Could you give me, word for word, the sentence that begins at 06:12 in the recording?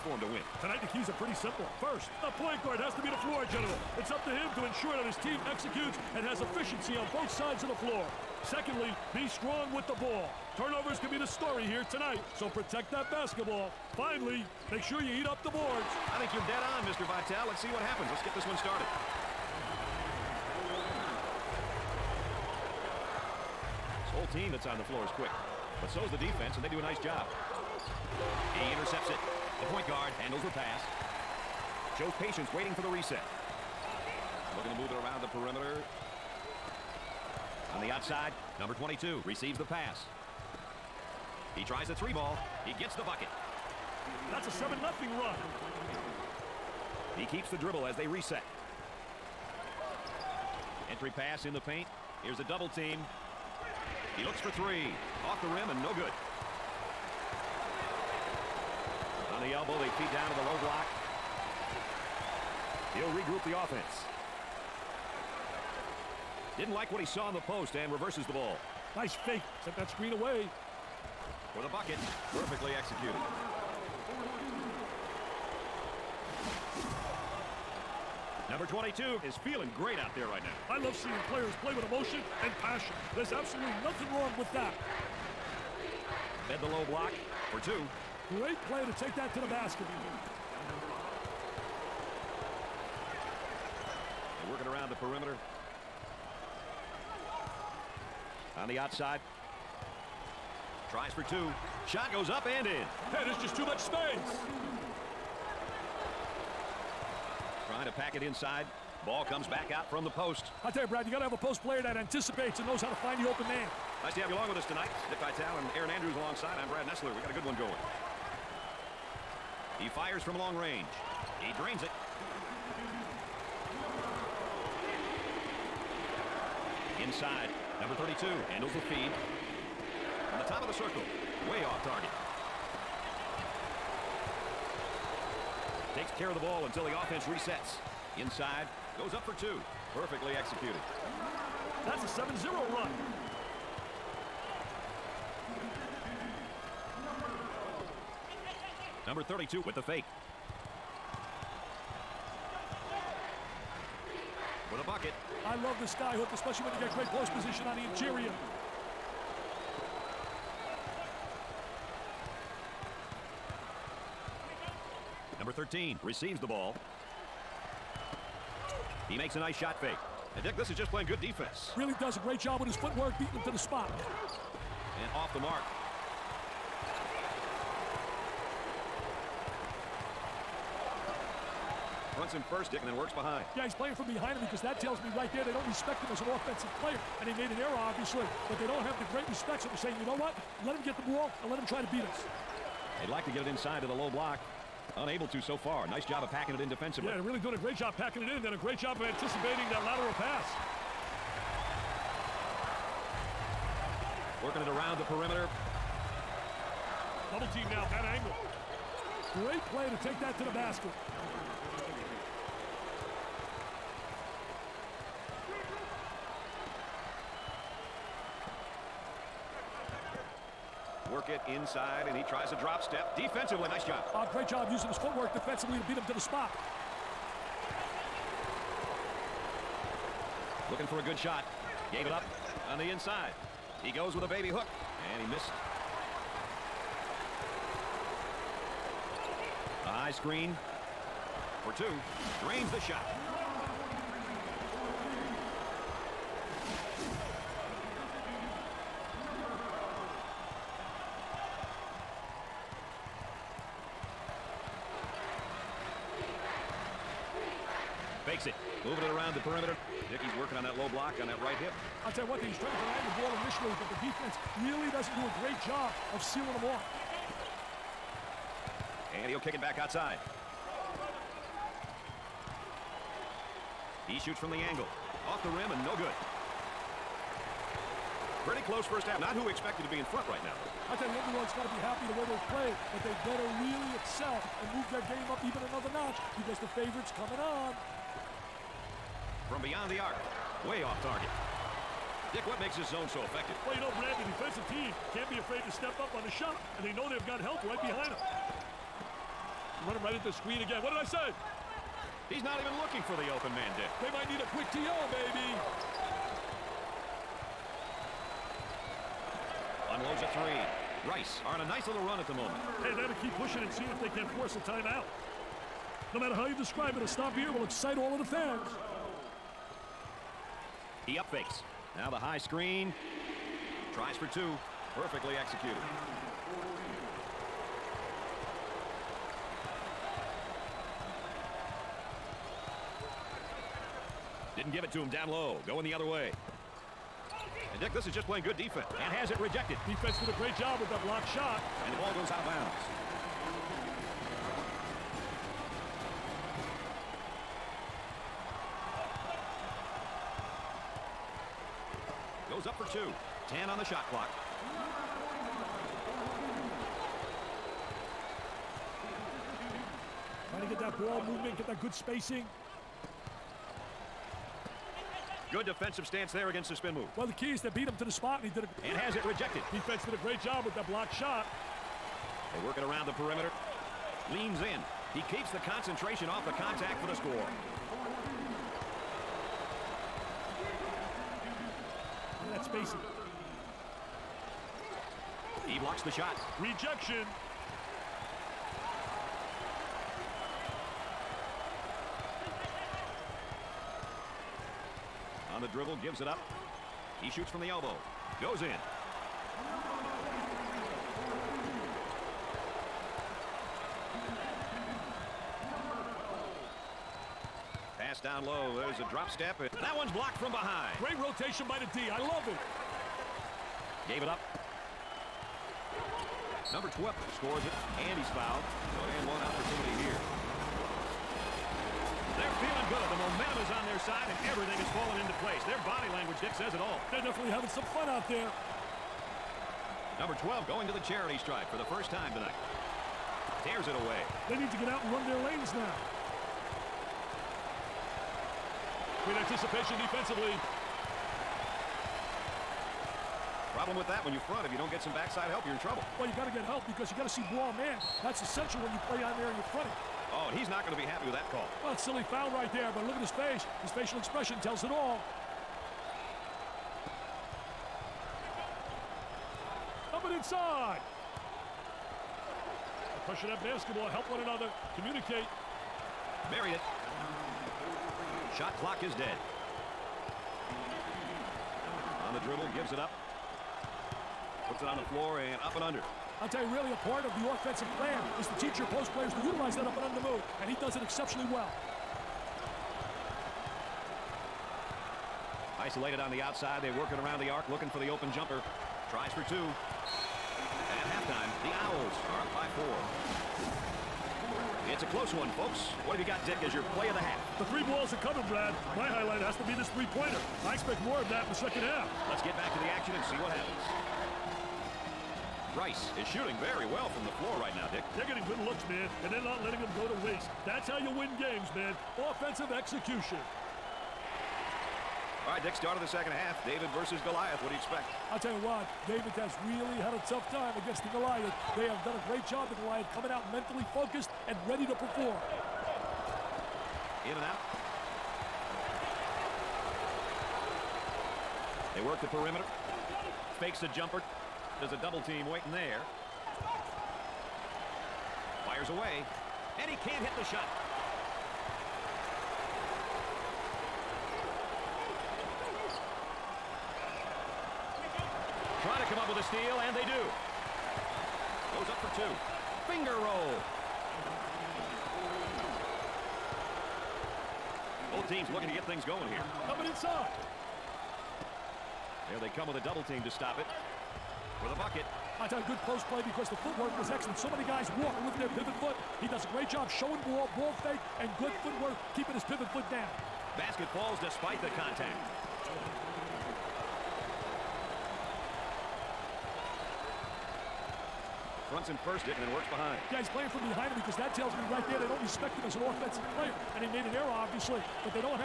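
They work it around the perimeter.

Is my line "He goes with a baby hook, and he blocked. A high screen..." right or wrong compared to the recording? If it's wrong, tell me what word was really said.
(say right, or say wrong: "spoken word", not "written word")
wrong: "missed", not "blocked".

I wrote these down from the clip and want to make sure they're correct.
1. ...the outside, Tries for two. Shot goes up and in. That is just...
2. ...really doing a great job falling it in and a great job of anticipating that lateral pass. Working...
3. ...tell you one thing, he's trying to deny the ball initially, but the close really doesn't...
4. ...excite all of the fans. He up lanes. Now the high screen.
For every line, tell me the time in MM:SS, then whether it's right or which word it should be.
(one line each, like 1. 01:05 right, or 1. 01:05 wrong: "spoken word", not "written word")
1. 01:38 right
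2. 03:17 wrong: "packing", not "falling"
3. 04:22 wrong: "defense", not "close"
4. 05:17 wrong: "fakes", not "lanes".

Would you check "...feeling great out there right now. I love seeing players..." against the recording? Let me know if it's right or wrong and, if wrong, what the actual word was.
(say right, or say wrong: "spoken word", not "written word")
right.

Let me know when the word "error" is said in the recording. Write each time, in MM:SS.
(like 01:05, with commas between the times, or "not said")
03:07, 09:47.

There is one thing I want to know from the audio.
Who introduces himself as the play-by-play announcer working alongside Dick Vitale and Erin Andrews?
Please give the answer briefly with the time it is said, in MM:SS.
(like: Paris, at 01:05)
Brad Nessler, at 01:56.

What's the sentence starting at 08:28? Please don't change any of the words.
They're getting good looks, man, and they're not letting them go to waste.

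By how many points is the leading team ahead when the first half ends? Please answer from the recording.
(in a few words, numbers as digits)
4.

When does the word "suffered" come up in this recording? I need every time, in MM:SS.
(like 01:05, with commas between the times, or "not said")
not said.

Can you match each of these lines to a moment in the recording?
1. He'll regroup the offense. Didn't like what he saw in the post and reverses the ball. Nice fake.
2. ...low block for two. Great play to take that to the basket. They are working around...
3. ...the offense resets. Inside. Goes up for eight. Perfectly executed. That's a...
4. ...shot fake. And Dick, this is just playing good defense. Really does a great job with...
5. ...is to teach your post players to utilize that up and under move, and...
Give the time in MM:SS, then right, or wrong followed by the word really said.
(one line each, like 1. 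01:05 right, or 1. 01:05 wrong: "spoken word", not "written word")
1. 01:02 right
2. 01:26 right
3. 02:16 wrong: "two", not "eight"
4. 02:49 right
5. 07:58 right.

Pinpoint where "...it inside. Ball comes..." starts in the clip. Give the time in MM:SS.
01:48.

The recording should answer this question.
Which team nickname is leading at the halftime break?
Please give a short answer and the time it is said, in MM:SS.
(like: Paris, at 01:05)
Owls, at 08:11.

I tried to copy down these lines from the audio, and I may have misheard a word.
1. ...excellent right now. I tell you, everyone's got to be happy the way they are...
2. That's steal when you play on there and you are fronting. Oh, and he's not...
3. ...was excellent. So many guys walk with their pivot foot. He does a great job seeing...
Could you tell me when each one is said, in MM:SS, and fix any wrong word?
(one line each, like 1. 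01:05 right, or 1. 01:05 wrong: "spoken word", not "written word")
1. 04:40 wrong: "front", not "excellent"
2. 07:28 wrong: "essential", not "steal"
3. 09:26 wrong: "showing", not "seeing".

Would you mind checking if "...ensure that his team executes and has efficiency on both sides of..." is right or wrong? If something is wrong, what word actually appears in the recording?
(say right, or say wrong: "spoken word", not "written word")
right.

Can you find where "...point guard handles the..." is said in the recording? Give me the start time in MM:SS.
00:29.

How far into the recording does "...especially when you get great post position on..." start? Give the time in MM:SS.
02:36.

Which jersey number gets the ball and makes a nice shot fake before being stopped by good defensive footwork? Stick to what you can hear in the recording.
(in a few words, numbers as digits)
13.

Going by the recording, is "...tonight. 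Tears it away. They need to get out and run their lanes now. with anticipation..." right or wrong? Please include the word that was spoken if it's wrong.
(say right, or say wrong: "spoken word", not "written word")
right.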